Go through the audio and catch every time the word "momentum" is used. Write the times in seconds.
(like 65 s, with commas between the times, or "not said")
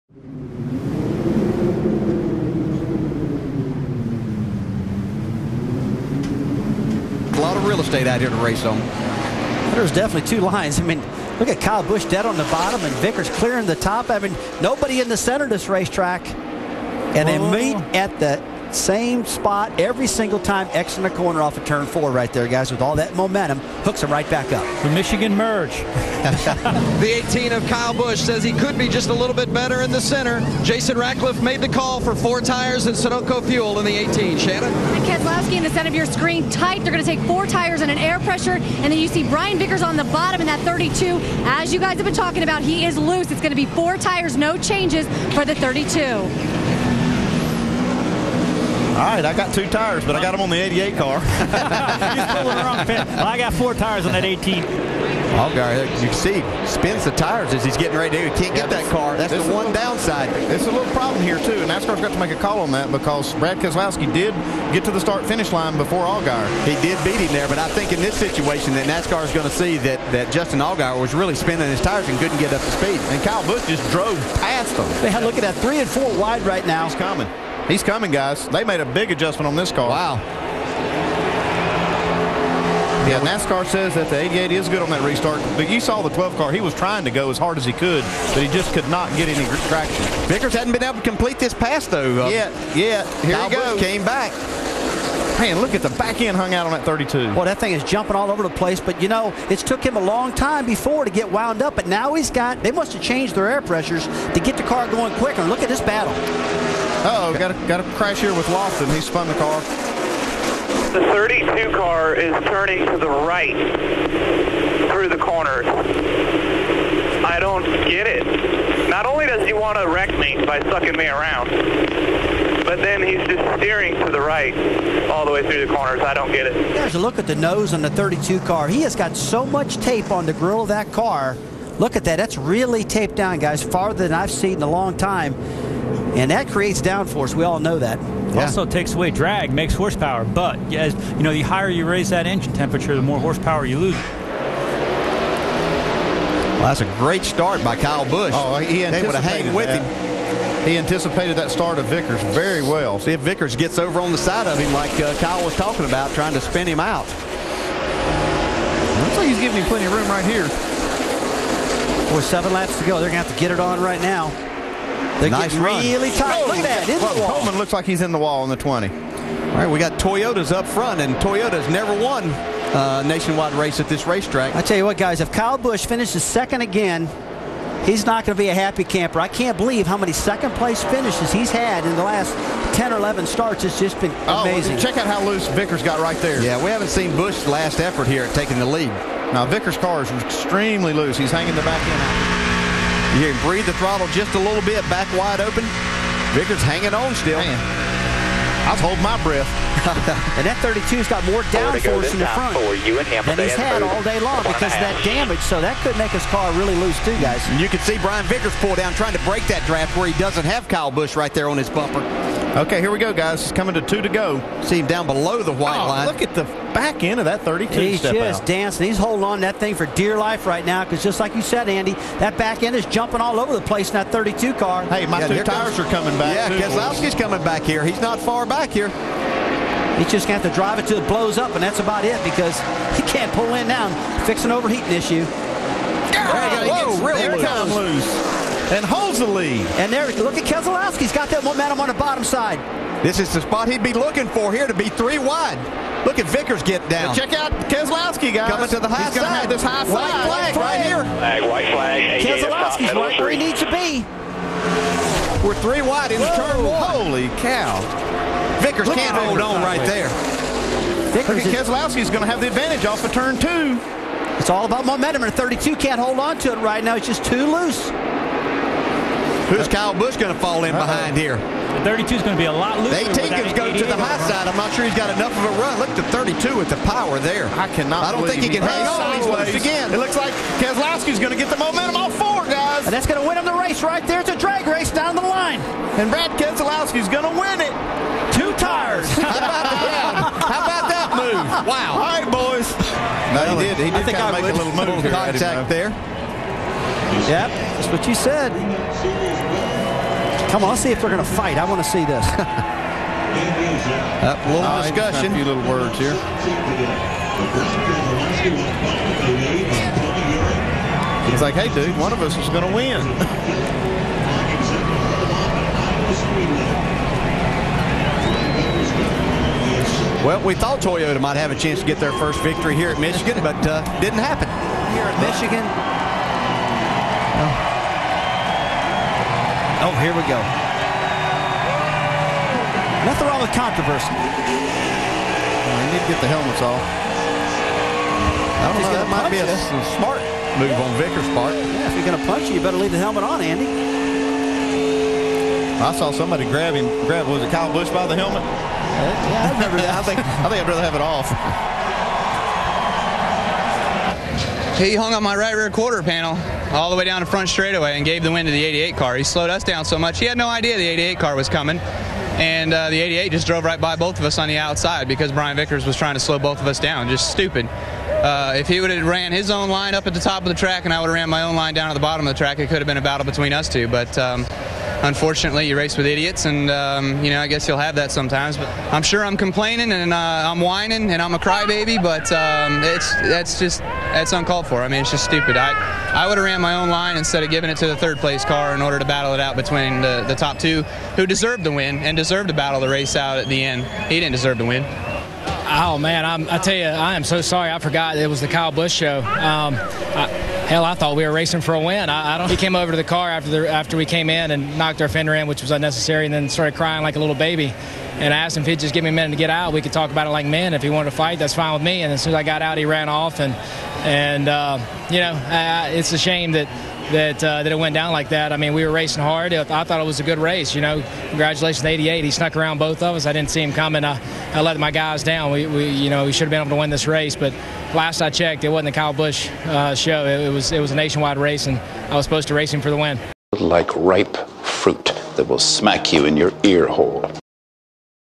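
23 s, 241 s, 264 s, 281 s.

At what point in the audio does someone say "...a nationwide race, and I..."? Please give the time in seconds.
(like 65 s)
430 s.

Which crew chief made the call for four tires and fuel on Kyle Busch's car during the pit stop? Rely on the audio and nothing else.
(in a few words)
Jason Ratcliff.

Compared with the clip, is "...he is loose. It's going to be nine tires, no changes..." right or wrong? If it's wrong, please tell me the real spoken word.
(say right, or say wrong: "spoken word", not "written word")
wrong: "four", not "nine".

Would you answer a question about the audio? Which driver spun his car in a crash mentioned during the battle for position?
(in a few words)
Lofton.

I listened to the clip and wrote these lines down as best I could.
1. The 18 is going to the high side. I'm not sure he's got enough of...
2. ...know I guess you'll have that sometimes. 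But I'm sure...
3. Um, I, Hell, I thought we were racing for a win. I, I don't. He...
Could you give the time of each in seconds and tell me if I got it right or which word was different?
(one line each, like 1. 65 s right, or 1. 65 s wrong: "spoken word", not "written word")
1. 273 s right
2. 377 s right
3. 399 s right.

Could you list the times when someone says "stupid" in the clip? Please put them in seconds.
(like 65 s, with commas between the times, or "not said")
367 s, 385 s.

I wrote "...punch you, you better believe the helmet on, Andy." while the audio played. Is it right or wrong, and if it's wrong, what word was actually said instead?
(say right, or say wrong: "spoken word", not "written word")
wrong: "leave", not "believe".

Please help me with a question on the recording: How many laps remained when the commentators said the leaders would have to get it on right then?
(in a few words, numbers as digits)
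7.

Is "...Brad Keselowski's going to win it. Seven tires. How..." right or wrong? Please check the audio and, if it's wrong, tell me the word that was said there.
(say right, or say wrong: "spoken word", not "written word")
wrong: "Two", not "Seven".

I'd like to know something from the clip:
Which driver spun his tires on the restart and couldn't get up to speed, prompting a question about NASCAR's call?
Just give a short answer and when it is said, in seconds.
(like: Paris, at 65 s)
Justin Allgaier, at 70 s.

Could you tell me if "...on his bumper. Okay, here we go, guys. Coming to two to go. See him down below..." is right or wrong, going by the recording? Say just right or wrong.
right.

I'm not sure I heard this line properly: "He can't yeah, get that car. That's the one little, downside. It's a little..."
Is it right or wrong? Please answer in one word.
right.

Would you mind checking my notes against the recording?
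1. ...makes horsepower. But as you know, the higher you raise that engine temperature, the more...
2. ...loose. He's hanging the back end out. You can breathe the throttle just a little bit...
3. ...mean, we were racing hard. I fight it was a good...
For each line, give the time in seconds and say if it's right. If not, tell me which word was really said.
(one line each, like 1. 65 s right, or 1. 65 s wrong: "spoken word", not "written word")
1. 139 s right
2. 190 s right
3. 418 s wrong: "thought", not "fight".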